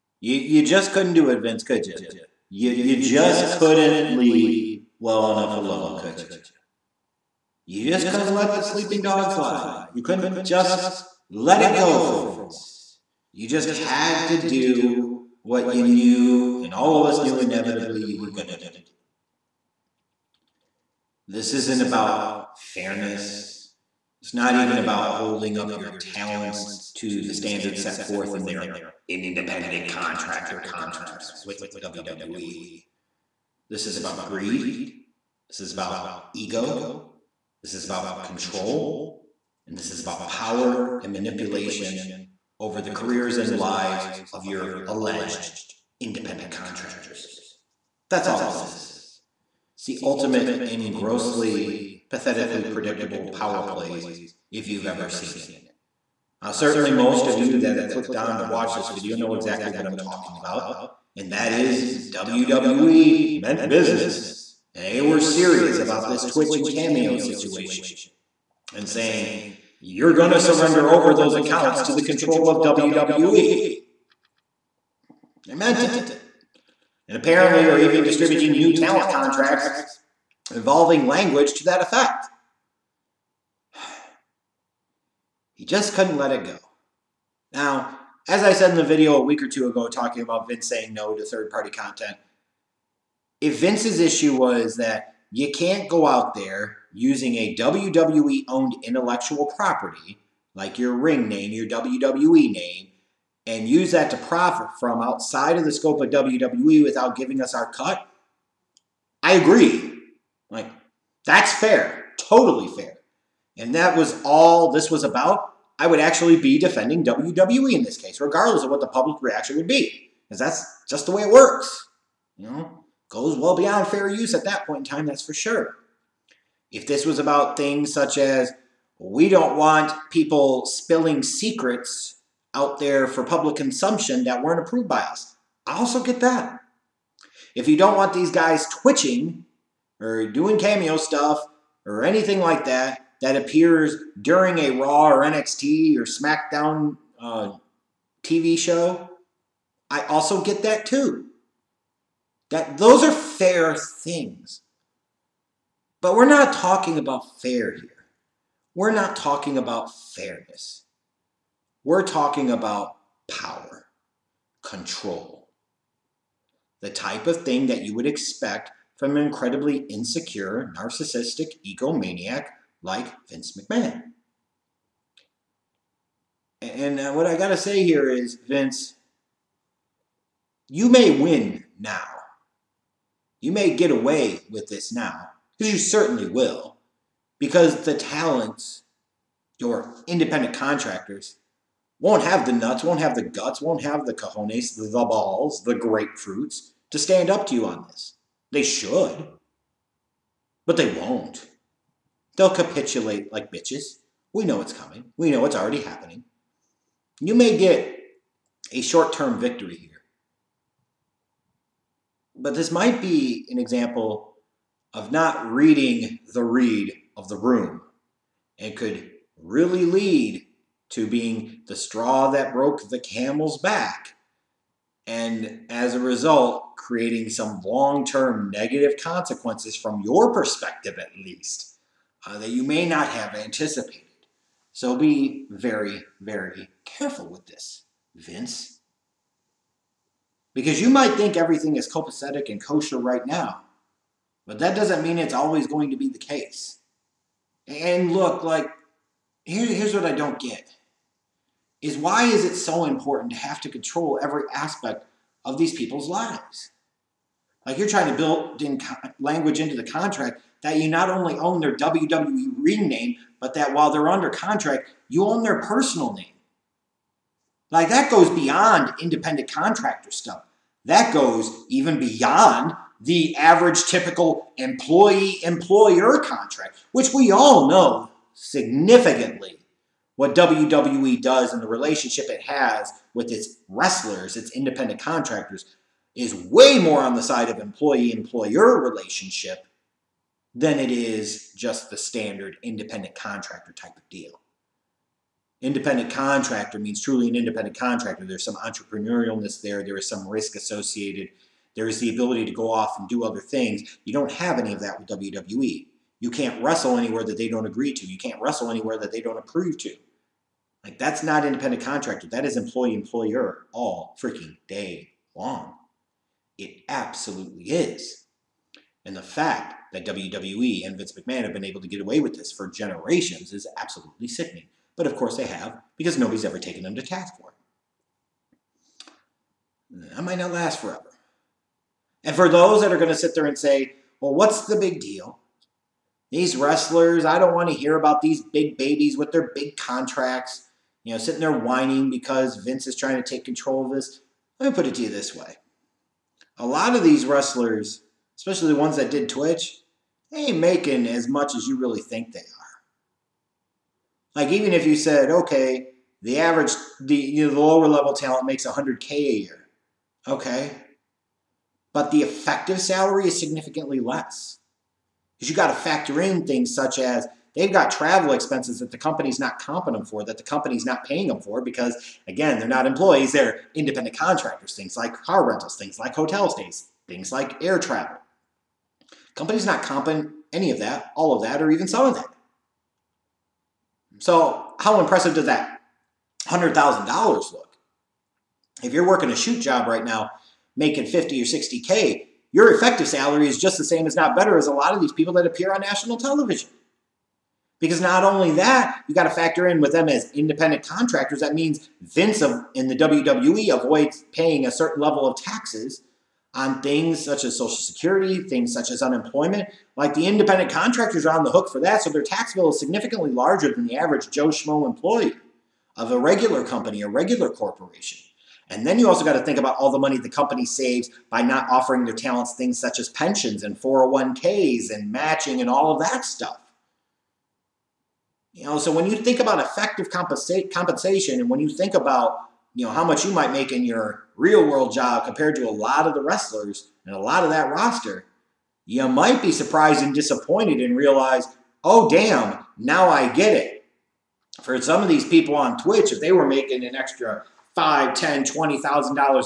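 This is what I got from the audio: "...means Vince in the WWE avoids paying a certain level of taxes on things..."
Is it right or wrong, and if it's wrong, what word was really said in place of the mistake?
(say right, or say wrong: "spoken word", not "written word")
right.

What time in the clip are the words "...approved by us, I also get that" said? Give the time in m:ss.
2:14.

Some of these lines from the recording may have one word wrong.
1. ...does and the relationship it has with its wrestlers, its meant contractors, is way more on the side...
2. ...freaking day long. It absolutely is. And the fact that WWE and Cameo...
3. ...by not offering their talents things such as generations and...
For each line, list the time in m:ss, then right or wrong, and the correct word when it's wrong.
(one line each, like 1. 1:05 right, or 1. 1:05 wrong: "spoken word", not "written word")
1. 4:41 wrong: "independent", not "meant"
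2. 5:14 wrong: "Vince", not "Cameo"
3. 7:01 wrong: "pensions", not "generations".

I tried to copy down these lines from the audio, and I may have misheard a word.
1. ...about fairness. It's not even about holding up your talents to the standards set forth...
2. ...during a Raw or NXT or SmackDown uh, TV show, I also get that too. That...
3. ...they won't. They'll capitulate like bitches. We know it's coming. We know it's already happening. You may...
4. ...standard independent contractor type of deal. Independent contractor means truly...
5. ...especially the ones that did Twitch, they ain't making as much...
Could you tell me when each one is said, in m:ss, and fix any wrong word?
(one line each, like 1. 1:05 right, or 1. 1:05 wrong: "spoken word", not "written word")
1. 0:21 right
2. 2:24 right
3. 3:20 right
4. 4:51 right
5. 5:48 right.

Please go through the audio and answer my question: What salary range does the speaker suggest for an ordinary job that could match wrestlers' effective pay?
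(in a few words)
50 or 60K.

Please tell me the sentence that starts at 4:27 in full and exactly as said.
Like that goes beyond independent contractor stuff.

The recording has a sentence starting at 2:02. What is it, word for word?
You know, goes well beyond fair use at that point in time, that's for sure.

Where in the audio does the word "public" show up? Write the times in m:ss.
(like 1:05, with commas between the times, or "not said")
1:58, 2:13.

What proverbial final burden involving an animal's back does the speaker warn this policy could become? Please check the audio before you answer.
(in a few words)
the straw that broke the camel's back.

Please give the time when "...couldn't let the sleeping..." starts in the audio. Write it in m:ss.
0:08.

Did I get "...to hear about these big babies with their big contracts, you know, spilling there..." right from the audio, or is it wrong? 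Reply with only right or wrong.
wrong.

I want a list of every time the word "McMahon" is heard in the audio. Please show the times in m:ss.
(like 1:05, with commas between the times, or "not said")
2:53, 5:21.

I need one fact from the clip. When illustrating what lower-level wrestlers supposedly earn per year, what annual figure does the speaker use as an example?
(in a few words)
100K.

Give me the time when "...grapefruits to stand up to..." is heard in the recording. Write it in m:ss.
3:15.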